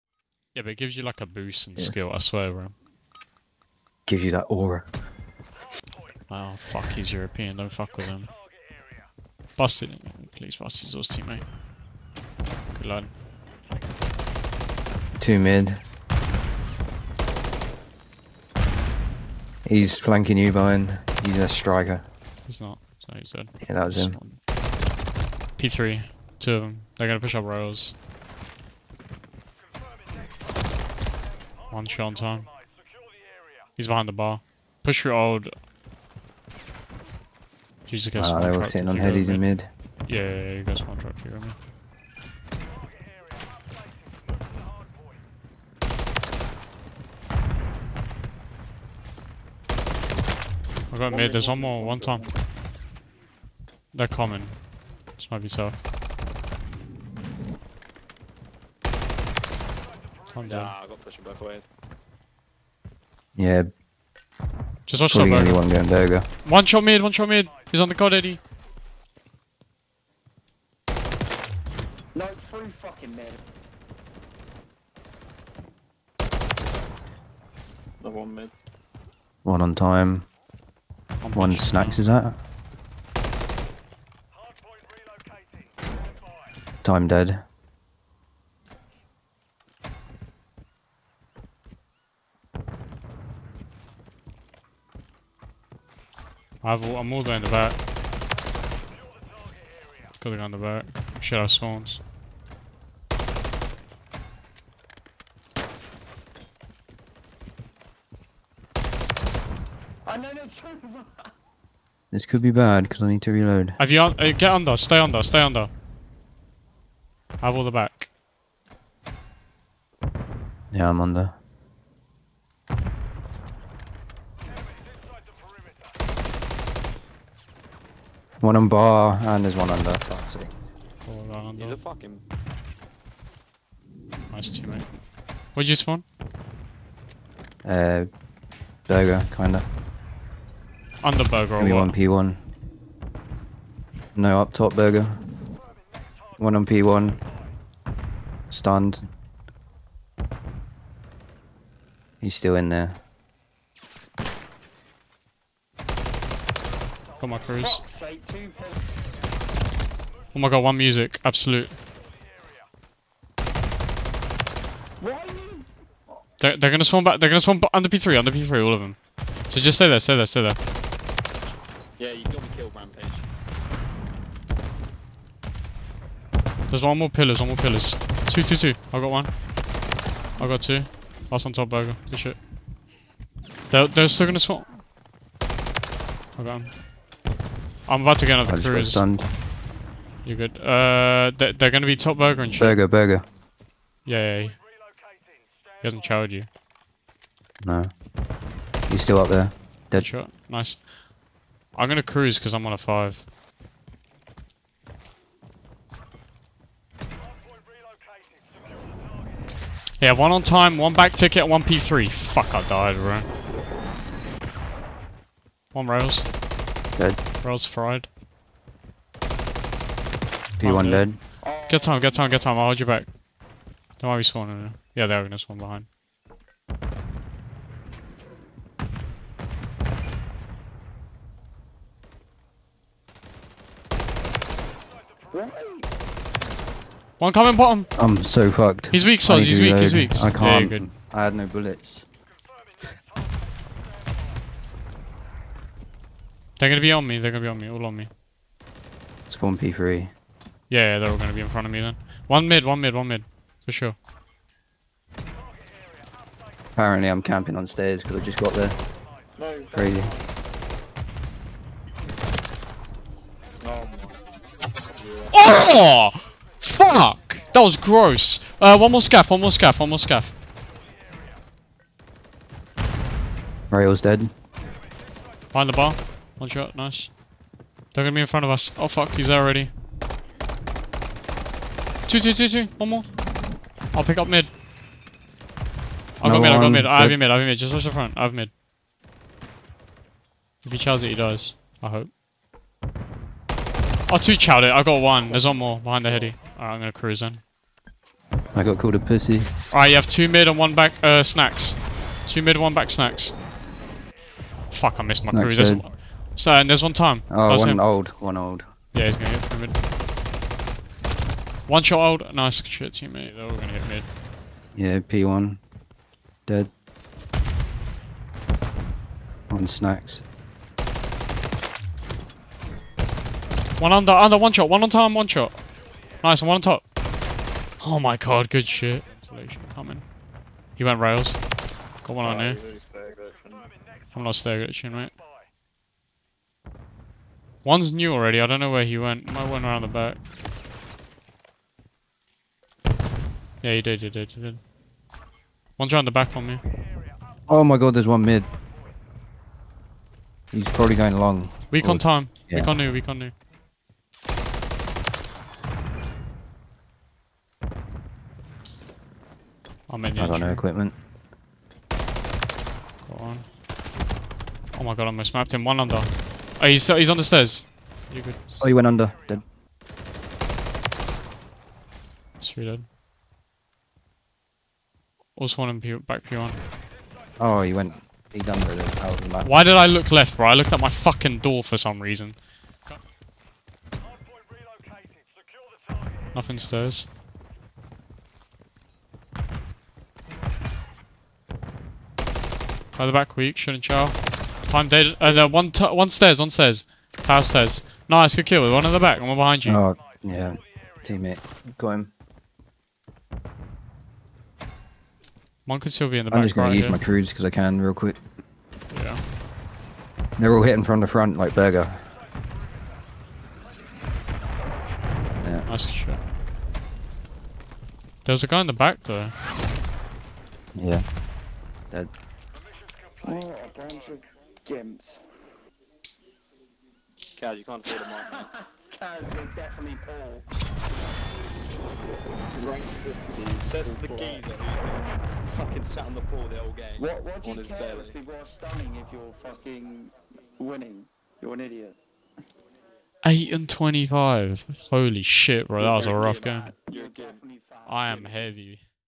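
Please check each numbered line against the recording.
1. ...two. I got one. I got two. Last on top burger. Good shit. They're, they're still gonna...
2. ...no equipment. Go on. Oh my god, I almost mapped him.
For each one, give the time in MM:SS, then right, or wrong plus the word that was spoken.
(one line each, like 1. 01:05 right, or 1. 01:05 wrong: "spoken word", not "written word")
1. 02:58 right
2. 06:00 right.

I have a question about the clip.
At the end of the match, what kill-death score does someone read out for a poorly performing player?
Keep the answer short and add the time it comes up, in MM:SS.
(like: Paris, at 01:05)
8 and 25, at 07:23.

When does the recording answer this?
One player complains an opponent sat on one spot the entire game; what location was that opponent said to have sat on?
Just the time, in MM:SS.
07:16.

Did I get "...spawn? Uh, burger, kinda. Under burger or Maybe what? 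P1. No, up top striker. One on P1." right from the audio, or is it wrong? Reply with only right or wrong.
wrong.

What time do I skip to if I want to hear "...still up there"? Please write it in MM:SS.
03:19.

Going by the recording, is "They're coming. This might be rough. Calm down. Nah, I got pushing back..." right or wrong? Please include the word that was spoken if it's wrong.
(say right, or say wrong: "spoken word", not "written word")
wrong: "tough", not "rough".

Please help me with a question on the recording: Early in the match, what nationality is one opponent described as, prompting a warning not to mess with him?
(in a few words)
European.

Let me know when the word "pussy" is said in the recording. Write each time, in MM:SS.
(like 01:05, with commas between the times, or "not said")
04:58.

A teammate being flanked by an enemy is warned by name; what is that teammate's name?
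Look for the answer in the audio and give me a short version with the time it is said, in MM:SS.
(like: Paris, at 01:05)
Brian, at 00:20.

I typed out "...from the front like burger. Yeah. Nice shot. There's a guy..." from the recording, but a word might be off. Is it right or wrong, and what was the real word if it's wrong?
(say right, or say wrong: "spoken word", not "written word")
right.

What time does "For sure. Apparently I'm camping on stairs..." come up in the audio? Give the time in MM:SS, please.
04:13.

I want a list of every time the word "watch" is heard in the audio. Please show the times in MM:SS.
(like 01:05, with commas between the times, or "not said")
01:05, 04:47.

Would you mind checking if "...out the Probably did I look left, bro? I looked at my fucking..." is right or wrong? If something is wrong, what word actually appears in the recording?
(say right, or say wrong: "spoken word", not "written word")
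wrong: "Why", not "Probably".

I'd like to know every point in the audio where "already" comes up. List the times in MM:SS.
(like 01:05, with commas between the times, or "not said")
04:39, 05:38.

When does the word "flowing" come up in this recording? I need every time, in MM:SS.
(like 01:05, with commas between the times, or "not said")
not said.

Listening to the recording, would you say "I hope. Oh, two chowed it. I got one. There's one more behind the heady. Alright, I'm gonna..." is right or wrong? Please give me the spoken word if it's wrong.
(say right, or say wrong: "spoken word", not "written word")
right.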